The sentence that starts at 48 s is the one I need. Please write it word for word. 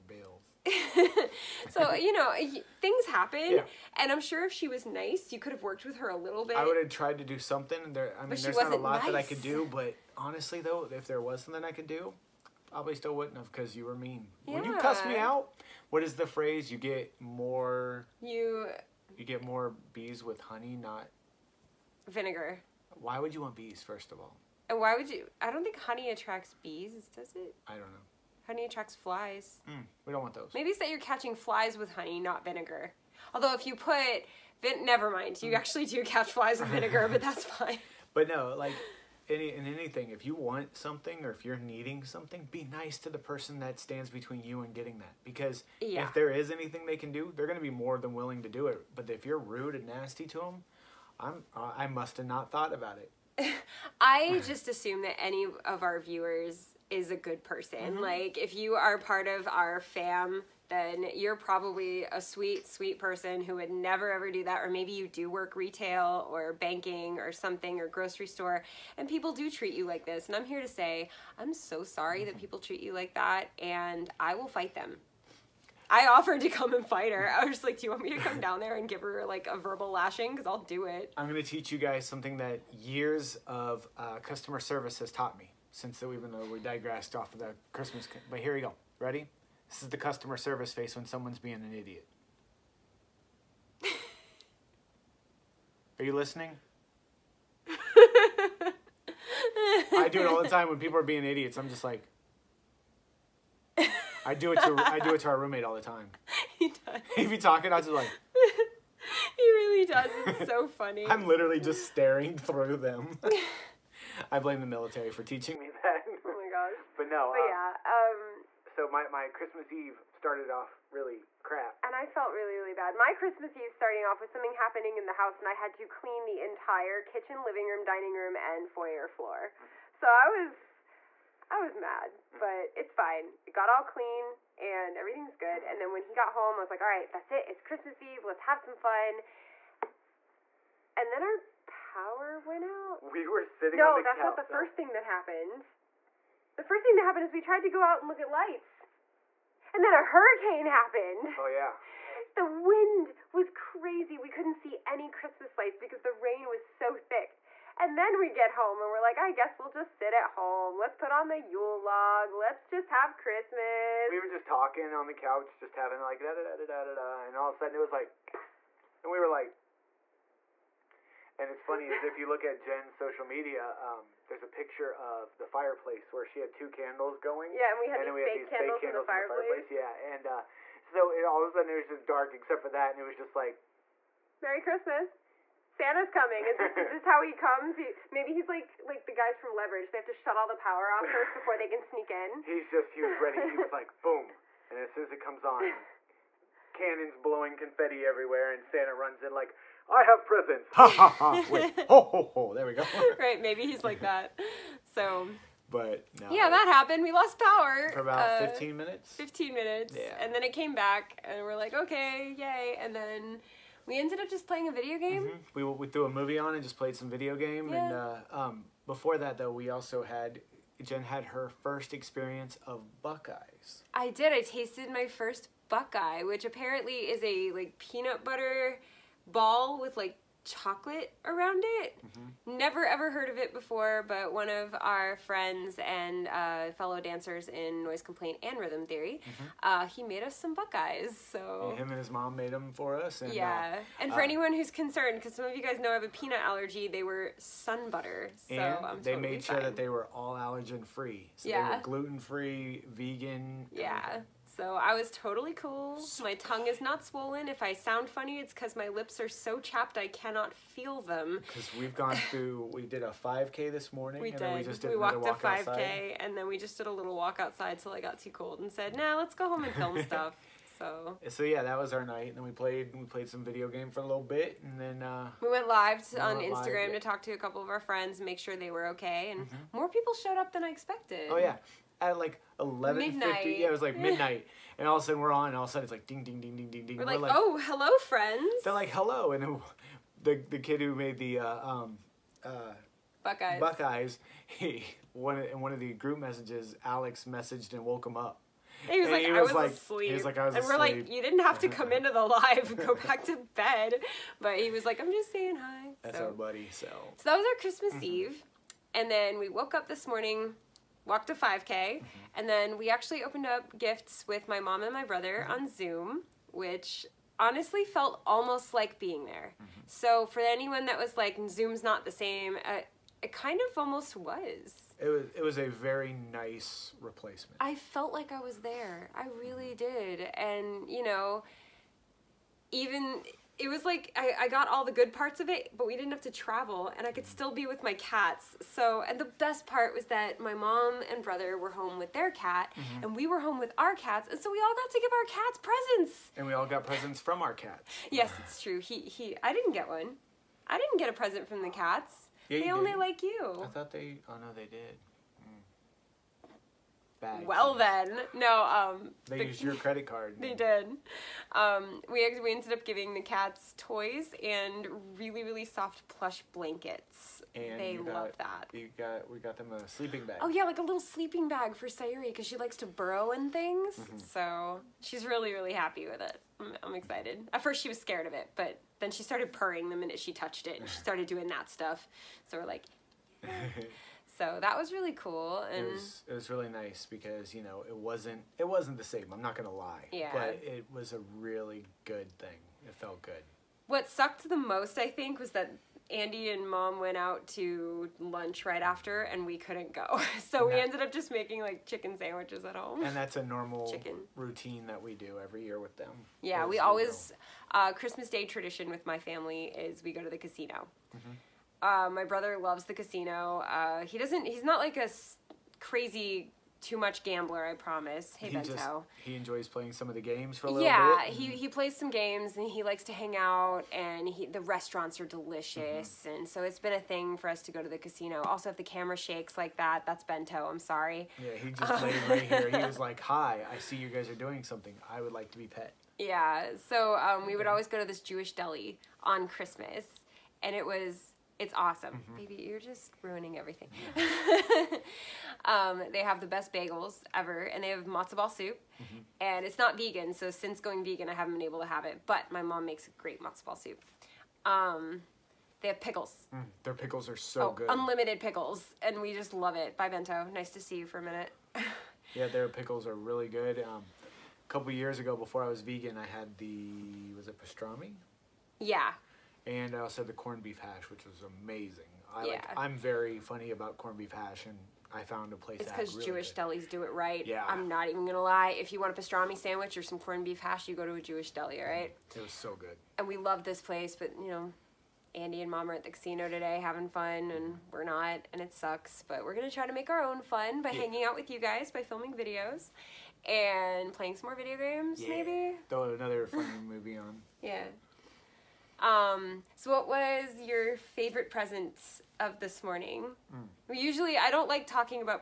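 But if you're rude and nasty to them, I'm uh, I must have not thought about it.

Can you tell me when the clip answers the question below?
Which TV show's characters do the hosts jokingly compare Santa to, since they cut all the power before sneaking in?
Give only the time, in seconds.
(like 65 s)
189 s.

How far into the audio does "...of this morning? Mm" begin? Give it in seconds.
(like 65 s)
502 s.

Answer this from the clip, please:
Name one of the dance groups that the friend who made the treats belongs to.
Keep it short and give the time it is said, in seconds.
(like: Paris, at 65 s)
Noise Complaint, at 237 s.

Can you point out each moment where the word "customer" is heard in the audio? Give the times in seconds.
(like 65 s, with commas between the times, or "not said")
84 s, 89 s.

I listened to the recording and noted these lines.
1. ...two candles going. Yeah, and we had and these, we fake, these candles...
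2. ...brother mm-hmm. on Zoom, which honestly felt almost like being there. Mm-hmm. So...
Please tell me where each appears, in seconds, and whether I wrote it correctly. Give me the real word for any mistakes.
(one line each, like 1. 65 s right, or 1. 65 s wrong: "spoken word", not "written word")
1. 176 s right
2. 315 s right.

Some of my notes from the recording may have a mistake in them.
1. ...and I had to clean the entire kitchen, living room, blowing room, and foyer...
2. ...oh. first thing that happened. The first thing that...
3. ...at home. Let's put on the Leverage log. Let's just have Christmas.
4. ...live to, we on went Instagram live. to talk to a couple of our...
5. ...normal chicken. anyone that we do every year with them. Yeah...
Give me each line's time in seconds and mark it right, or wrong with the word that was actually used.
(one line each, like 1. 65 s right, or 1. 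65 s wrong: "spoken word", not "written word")
1. 125 s wrong: "dining", not "blowing"
2. 144 s right
3. 160 s wrong: "Yule", not "Leverage"
4. 275 s right
5. 403 s wrong: "routine", not "anyone".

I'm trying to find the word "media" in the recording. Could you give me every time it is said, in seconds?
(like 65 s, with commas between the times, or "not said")
173 s.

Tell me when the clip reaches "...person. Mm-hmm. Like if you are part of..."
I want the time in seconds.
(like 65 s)
57 s.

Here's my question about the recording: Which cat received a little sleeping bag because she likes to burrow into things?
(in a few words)
Sayuri.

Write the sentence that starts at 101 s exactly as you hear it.
I'm just like, I do it to I do it to our roommate all the time.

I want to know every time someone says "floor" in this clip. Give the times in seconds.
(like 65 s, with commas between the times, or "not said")
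129 s.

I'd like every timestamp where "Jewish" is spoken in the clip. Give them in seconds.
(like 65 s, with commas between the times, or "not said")
438 s, 476 s, 481 s.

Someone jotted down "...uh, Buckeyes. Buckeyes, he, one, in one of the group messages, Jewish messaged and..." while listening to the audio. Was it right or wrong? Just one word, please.
wrong.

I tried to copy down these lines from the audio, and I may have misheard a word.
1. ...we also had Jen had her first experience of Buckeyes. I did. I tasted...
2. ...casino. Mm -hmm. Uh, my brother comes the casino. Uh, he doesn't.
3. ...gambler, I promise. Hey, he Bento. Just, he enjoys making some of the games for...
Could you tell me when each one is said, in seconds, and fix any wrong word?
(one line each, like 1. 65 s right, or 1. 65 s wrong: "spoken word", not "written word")
1. 219 s right
2. 410 s wrong: "loves", not "comes"
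3. 417 s wrong: "playing", not "making".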